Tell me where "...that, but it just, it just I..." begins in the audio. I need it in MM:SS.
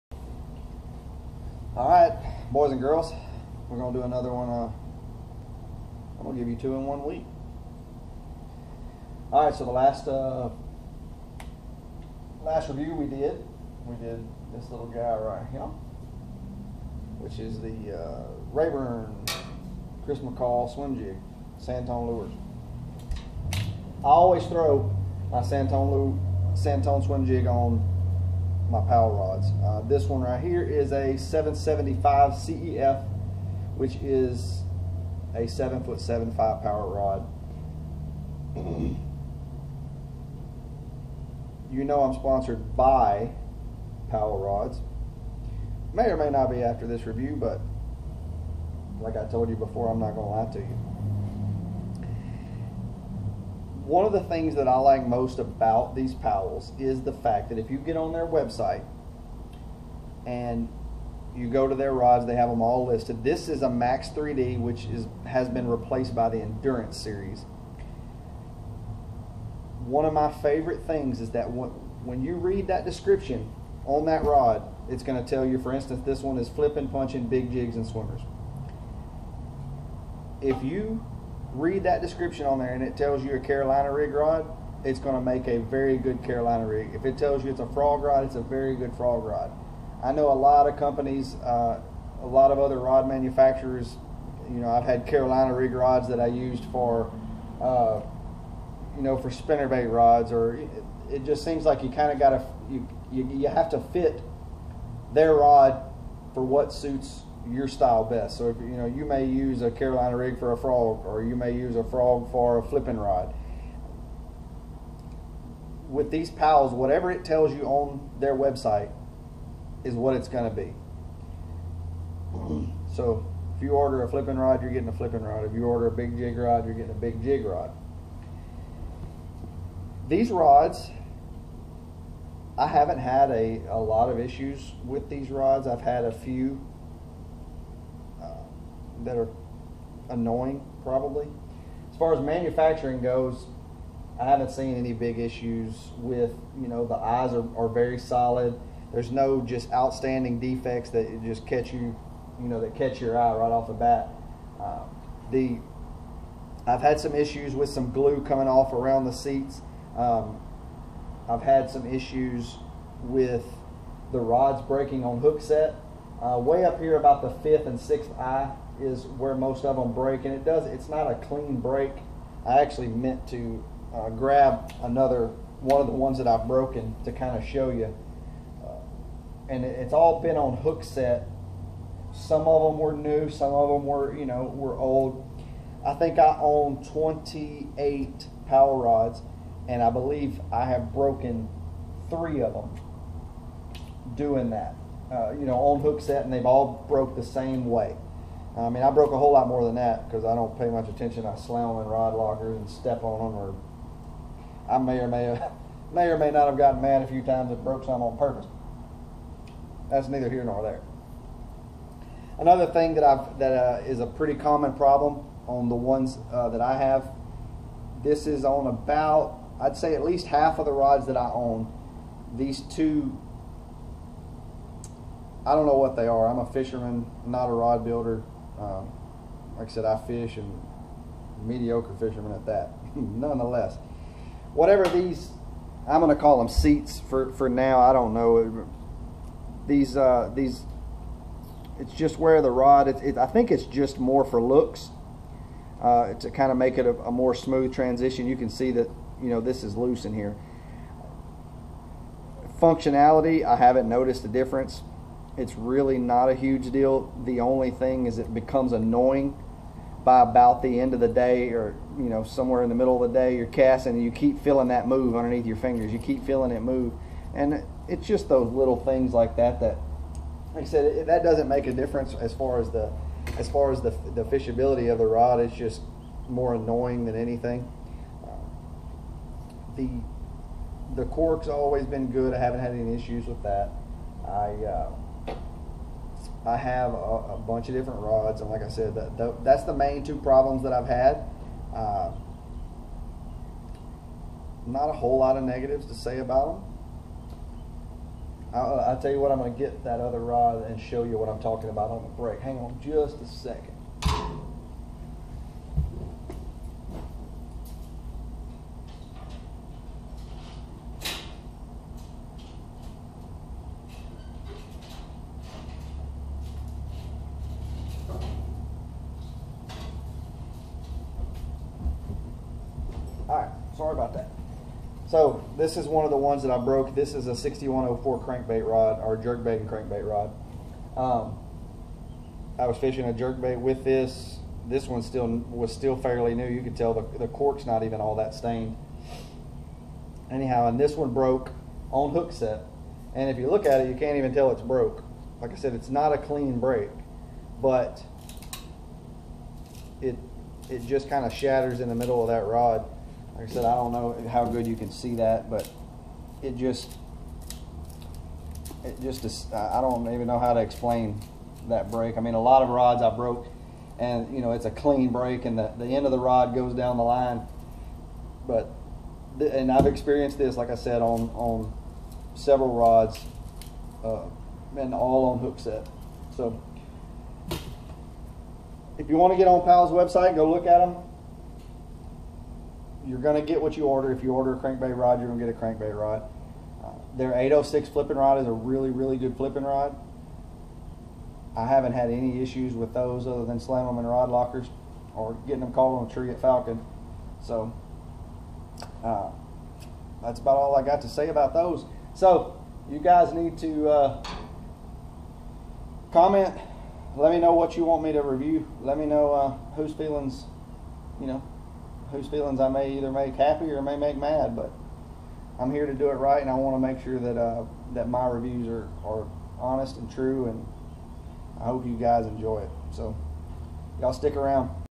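05:55.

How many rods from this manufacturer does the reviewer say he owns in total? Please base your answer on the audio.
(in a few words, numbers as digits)
28.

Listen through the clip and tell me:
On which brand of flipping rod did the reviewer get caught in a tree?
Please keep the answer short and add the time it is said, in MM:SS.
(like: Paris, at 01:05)
Falcon, at 06:36.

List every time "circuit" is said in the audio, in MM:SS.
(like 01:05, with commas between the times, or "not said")
not said.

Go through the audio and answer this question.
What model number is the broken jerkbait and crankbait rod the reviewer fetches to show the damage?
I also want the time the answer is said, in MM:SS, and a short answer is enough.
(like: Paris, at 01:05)
6104, at 05:27.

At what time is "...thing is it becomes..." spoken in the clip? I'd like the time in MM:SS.
04:17.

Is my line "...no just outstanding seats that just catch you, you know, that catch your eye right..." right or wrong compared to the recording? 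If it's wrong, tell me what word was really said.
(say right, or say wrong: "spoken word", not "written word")
wrong: "defects", not "seats".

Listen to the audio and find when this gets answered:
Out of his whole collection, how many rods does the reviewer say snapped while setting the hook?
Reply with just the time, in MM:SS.
03:12.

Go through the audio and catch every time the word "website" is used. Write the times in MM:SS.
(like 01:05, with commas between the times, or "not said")
00:58, 01:58, 06:19.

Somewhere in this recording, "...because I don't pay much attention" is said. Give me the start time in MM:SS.
03:20.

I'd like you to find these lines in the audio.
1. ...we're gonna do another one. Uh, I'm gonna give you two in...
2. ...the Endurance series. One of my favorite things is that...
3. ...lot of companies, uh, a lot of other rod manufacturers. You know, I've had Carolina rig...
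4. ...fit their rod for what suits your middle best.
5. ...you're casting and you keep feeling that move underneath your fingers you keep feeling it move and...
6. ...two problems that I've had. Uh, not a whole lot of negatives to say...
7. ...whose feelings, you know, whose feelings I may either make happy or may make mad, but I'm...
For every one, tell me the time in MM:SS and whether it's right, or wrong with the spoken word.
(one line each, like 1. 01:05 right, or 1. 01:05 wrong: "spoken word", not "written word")
1. 00:03 right
2. 01:06 right
3. 01:30 right
4. 01:43 wrong: "style", not "middle"
5. 04:23 right
6. 04:50 right
7. 06:49 right.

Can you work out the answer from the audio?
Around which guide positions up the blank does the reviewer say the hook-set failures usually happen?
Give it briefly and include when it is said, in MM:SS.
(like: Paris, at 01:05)
fifth and sixth eye, at 02:47.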